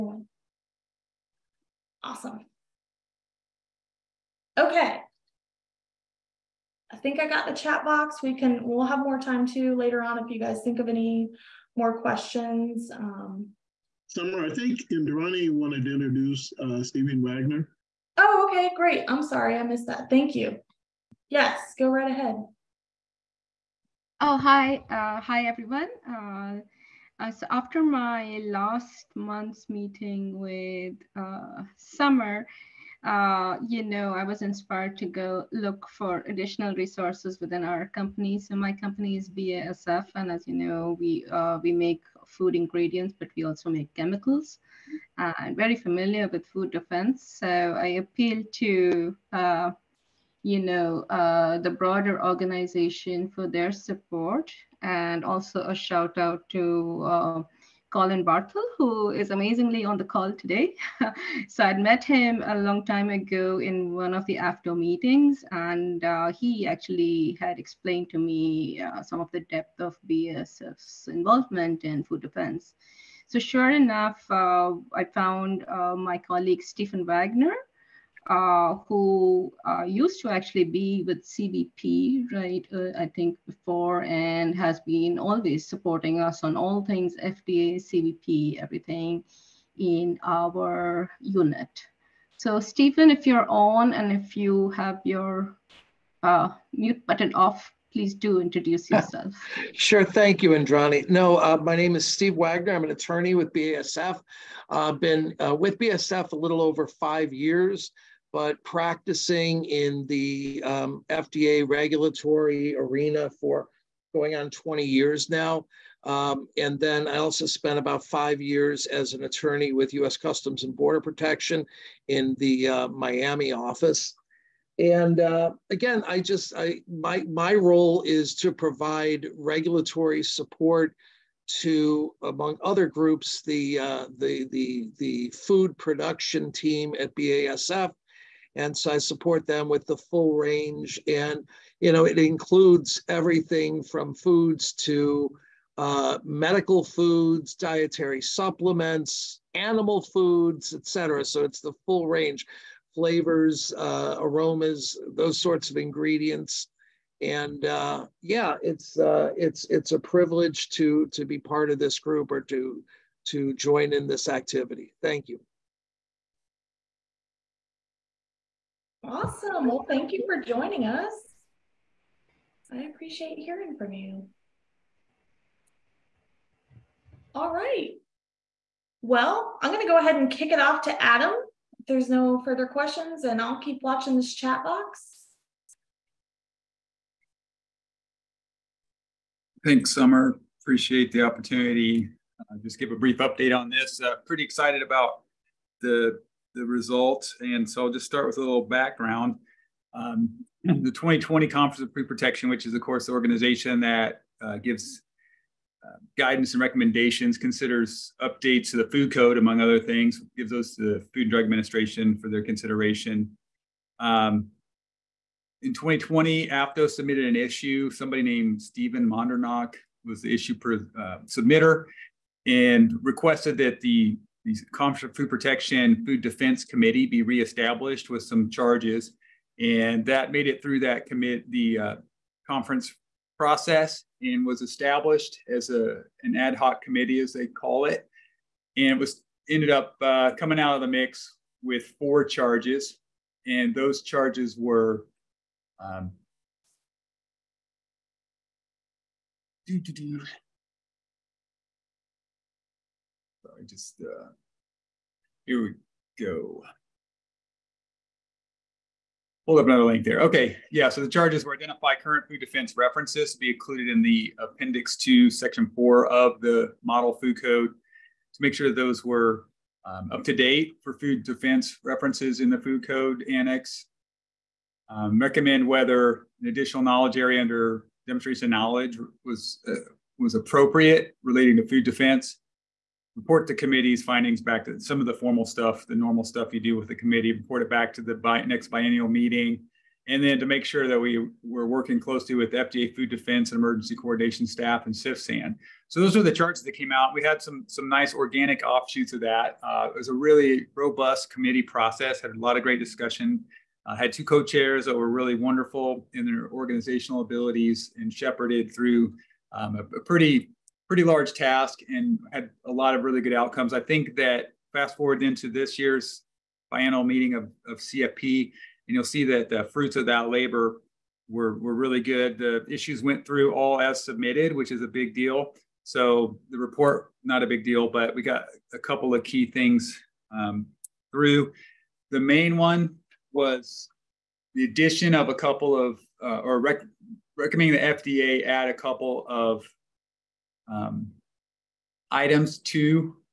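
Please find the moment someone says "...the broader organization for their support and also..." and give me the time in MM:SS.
00:51.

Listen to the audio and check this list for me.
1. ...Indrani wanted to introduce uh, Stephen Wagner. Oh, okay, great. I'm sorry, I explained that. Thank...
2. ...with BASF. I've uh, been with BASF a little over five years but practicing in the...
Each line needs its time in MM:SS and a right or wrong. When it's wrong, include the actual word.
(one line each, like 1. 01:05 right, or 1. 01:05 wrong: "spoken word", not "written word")
1. 00:14 wrong: "missed", not "explained"
2. 01:43 right.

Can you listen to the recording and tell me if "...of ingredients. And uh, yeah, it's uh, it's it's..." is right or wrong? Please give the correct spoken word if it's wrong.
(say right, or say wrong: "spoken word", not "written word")
right.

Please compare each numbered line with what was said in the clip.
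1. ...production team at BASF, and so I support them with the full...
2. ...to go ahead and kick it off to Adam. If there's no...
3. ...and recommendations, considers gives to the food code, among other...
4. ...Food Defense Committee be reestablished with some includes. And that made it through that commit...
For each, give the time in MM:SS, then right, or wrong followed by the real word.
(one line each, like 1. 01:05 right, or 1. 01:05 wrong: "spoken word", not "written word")
1. 02:15 right
2. 02:59 right
3. 03:26 wrong: "updates", not "gives"
4. 03:46 wrong: "charges", not "includes".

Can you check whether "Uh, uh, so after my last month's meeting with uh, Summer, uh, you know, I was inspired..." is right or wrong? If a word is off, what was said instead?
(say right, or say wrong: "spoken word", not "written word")
right.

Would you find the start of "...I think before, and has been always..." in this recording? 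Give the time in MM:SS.
01:22.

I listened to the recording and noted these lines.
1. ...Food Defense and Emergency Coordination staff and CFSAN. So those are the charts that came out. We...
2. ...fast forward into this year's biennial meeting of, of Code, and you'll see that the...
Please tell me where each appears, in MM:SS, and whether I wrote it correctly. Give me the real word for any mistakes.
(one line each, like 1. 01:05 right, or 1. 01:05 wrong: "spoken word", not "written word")
1. 04:52 right
2. 05:14 wrong: "CFP", not "Code".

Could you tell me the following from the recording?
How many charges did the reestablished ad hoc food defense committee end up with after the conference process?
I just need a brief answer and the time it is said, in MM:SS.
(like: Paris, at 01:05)
4, at 04:01.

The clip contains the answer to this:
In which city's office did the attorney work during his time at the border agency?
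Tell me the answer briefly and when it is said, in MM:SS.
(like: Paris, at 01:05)
Miami, at 02:02.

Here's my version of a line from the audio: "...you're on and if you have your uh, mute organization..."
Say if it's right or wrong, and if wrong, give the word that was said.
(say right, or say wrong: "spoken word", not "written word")
wrong: "button", not "organization".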